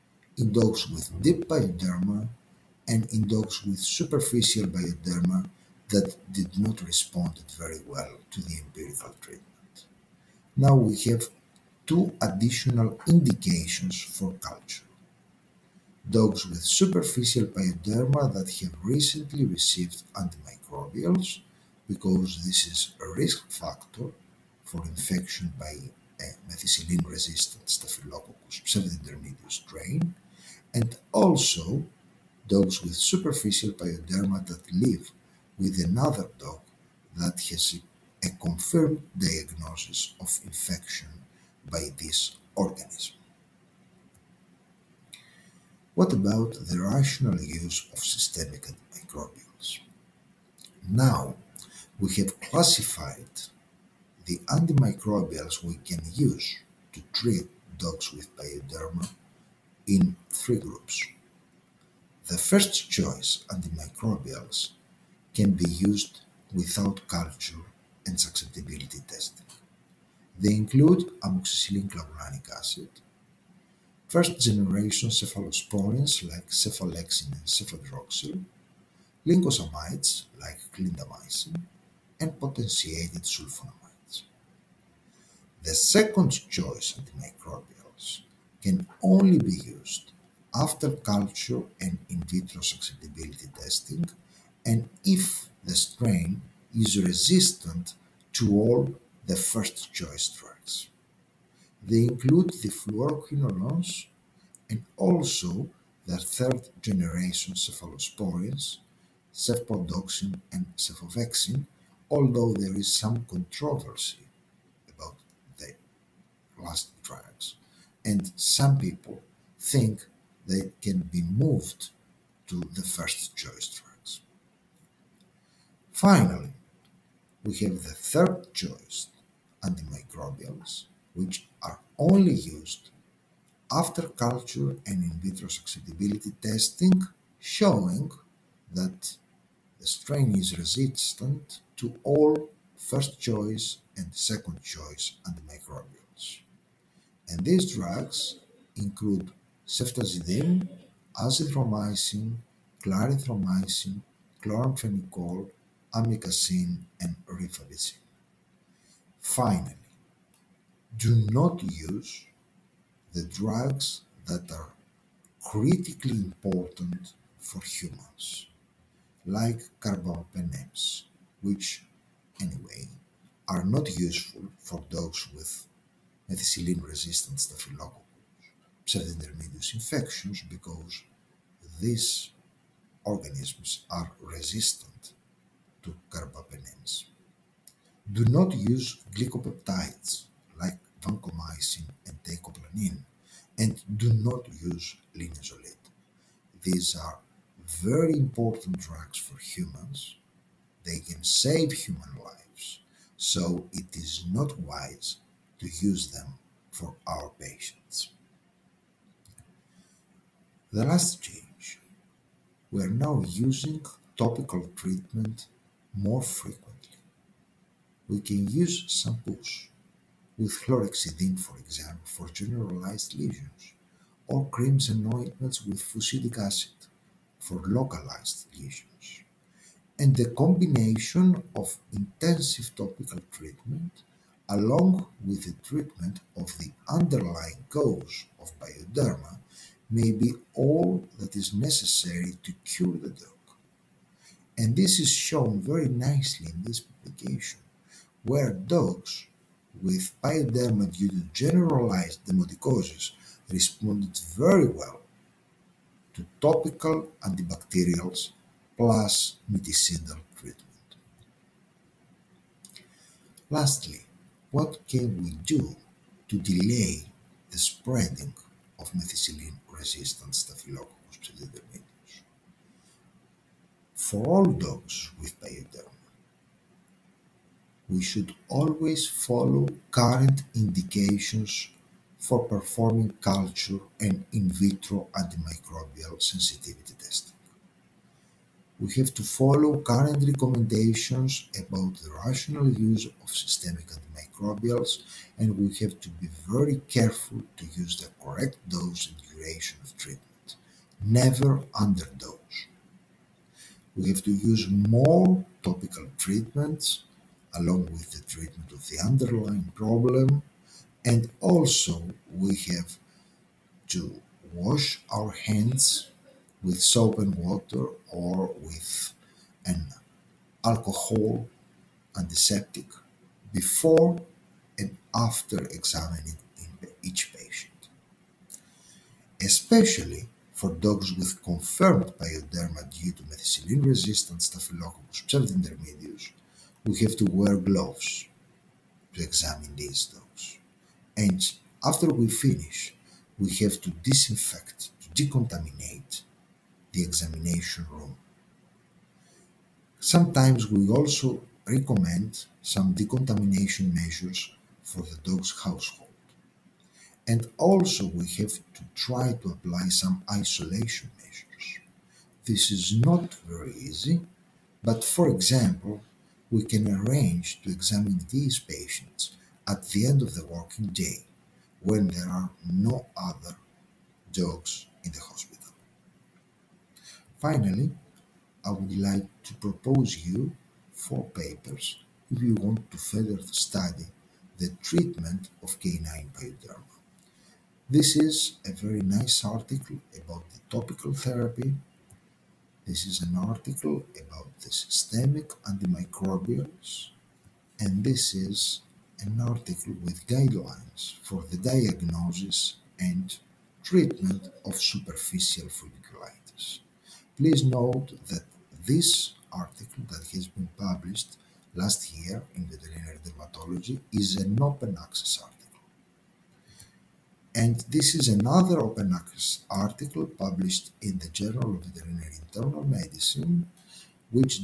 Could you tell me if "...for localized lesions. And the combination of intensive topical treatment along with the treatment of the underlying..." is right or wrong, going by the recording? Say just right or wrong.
right.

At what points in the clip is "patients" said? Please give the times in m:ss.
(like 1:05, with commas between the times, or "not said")
3:27, 5:27, 6:08.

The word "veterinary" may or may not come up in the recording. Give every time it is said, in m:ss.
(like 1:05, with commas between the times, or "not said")
6:52, 7:01.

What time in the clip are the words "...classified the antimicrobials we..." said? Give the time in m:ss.
0:52.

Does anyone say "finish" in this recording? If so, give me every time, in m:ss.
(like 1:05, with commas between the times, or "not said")
5:42.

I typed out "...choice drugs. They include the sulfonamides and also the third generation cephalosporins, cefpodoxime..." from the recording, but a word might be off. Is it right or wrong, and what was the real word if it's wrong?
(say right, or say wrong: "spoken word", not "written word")
wrong: "fluoroquinolones", not "sulfonamides".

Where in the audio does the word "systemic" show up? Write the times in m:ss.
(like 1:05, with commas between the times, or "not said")
0:48, 4:53, 6:34.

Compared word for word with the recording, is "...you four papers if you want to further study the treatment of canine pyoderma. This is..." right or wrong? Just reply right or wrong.
right.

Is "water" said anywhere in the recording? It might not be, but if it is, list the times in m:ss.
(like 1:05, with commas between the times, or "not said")
5:17.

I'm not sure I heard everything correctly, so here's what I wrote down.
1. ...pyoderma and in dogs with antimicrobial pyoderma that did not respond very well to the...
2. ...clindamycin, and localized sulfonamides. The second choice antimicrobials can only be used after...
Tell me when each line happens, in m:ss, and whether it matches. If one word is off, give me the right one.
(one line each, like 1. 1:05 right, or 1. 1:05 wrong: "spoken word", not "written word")
1. 0:01 wrong: "superficial", not "antimicrobial"
2. 1:20 wrong: "potentiated", not "localized".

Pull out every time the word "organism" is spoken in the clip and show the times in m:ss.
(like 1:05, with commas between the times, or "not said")
0:42, 3:03.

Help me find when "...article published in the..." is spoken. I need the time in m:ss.
6:59.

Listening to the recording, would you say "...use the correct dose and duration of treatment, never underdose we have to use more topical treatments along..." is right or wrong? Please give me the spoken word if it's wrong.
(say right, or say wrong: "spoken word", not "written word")
right.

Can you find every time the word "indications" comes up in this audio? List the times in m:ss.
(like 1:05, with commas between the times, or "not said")
0:13, 4:40.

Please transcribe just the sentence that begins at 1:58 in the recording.
And some people think they can be moved to the first choice drugs.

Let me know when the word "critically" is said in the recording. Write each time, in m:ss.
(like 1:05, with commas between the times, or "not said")
2:45.